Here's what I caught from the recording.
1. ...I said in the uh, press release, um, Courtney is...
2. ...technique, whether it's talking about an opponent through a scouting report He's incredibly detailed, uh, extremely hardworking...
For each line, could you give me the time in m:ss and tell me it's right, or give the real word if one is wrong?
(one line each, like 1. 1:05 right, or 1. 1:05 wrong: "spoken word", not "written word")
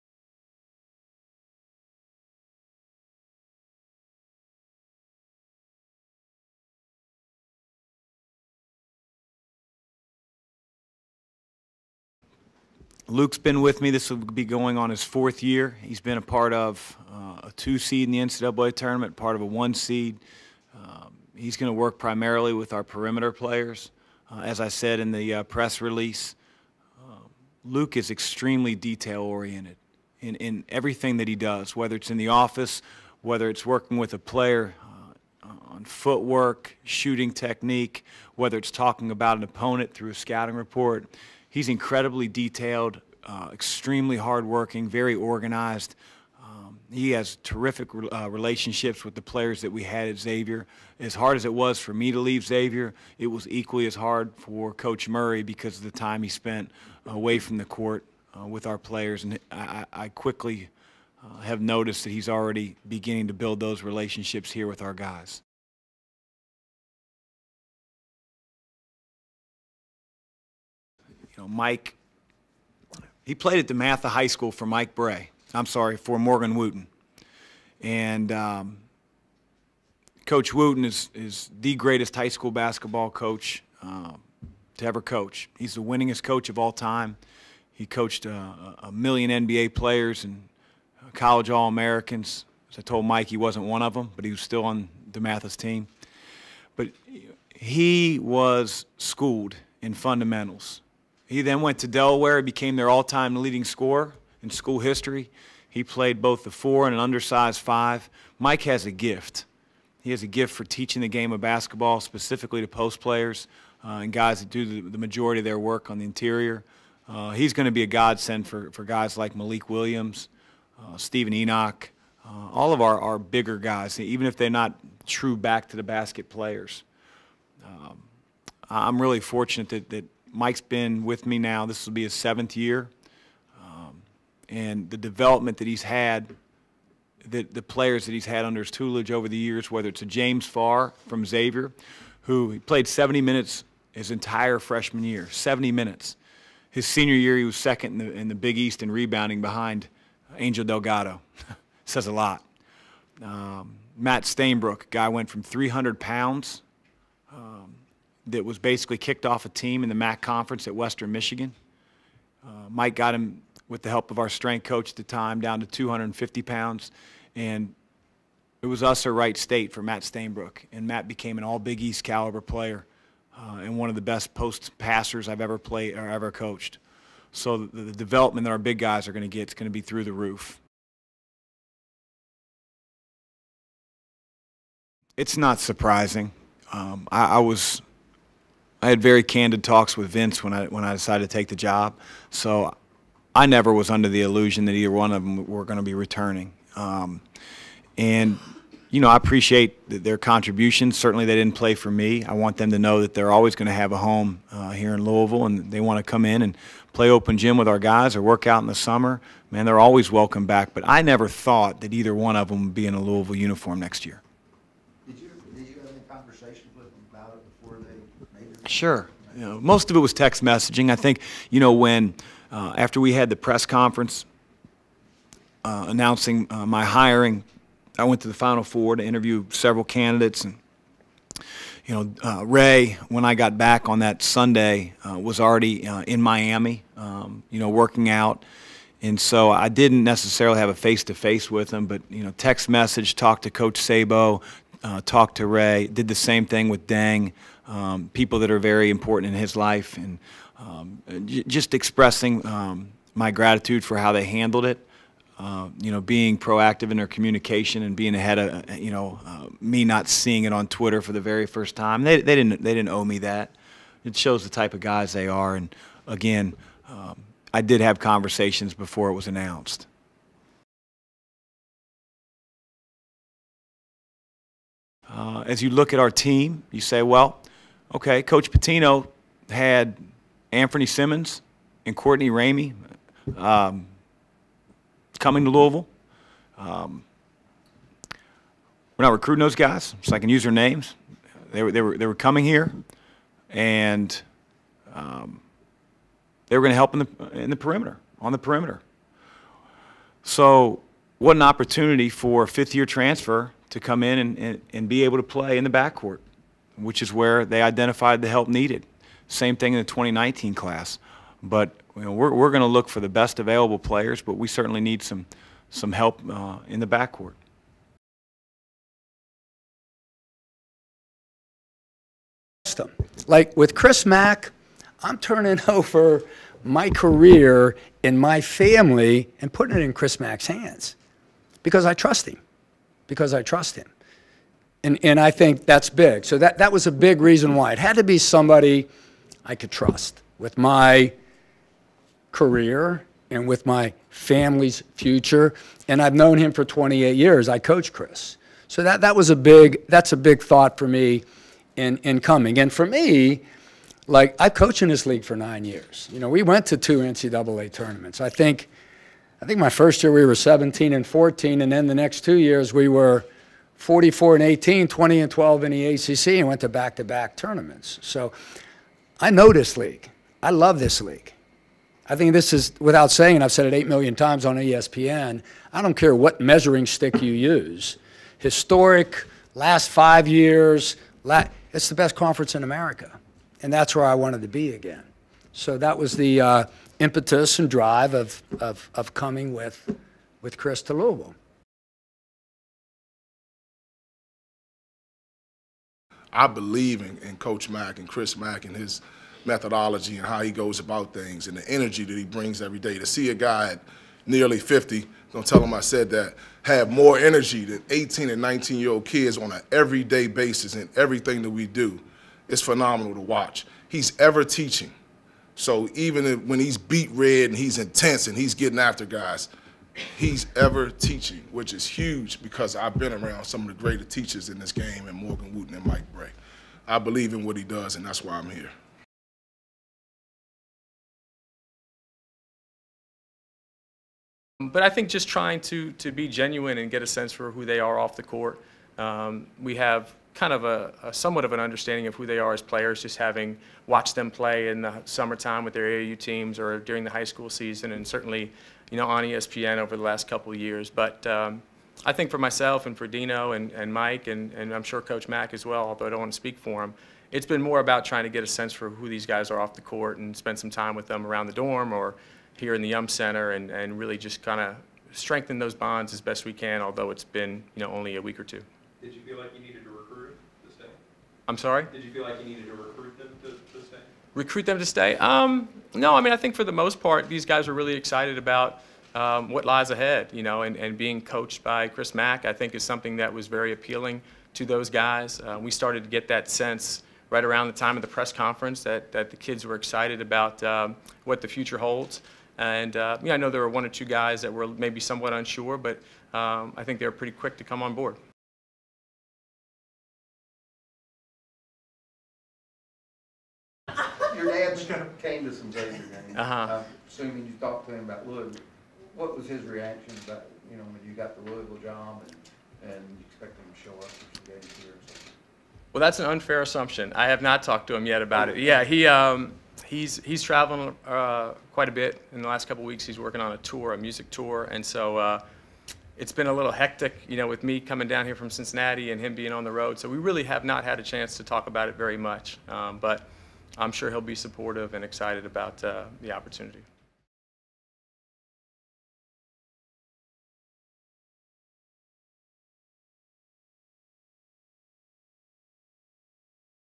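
1. 0:24 wrong: "Luke", not "Courtney"
2. 0:37 right.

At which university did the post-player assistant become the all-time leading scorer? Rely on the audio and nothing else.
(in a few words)
Delaware.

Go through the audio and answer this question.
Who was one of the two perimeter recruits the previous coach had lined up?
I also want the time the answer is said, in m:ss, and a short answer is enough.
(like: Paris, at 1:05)
Anfernee Simons, at 4:40.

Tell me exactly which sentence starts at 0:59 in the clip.
And I, I quickly uh, have noticed that he's already beginning to build those relationships here with our guys.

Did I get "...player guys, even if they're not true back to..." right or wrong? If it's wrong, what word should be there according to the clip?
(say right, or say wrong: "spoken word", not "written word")
wrong: "bigger", not "player".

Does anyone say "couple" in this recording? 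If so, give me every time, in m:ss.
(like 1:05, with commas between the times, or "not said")
7:30, 8:42.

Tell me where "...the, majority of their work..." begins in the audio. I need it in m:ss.
1:54.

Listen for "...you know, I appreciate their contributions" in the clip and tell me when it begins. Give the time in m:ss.
3:18.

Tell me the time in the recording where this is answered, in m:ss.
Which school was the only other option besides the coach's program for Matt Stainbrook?
2:49.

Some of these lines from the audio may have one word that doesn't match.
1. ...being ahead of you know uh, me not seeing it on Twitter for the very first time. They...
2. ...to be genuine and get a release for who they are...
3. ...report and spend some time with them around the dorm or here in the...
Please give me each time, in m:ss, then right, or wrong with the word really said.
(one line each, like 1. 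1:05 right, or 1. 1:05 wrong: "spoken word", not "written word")
1. 4:17 right
2. 7:15 wrong: "sense", not "release"
3. 7:39 wrong: "court", not "report".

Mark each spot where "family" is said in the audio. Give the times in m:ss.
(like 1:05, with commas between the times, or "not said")
5:28, 5:44.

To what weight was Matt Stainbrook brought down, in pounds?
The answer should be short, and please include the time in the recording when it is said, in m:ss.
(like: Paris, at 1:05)
250, at 2:45.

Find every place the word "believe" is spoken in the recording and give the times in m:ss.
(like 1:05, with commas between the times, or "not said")
6:36, 7:06.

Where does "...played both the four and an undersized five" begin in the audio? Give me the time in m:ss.
1:45.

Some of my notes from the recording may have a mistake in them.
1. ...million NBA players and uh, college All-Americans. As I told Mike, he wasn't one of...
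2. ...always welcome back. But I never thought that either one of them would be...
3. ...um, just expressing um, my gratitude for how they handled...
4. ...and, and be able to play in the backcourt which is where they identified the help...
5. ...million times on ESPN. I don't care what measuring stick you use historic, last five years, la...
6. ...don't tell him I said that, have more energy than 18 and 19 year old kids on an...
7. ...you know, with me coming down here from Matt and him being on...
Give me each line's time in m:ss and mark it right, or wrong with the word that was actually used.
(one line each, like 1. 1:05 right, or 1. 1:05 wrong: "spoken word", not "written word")
1. 1:28 right
2. 3:29 right
3. 4:10 right
4. 5:04 right
5. 6:13 right
6. 6:45 right
7. 8:47 wrong: "Cincinnati", not "Matt".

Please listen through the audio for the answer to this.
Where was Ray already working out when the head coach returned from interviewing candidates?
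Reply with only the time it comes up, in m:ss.
3:56.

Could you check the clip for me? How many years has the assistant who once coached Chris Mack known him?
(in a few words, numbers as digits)
28.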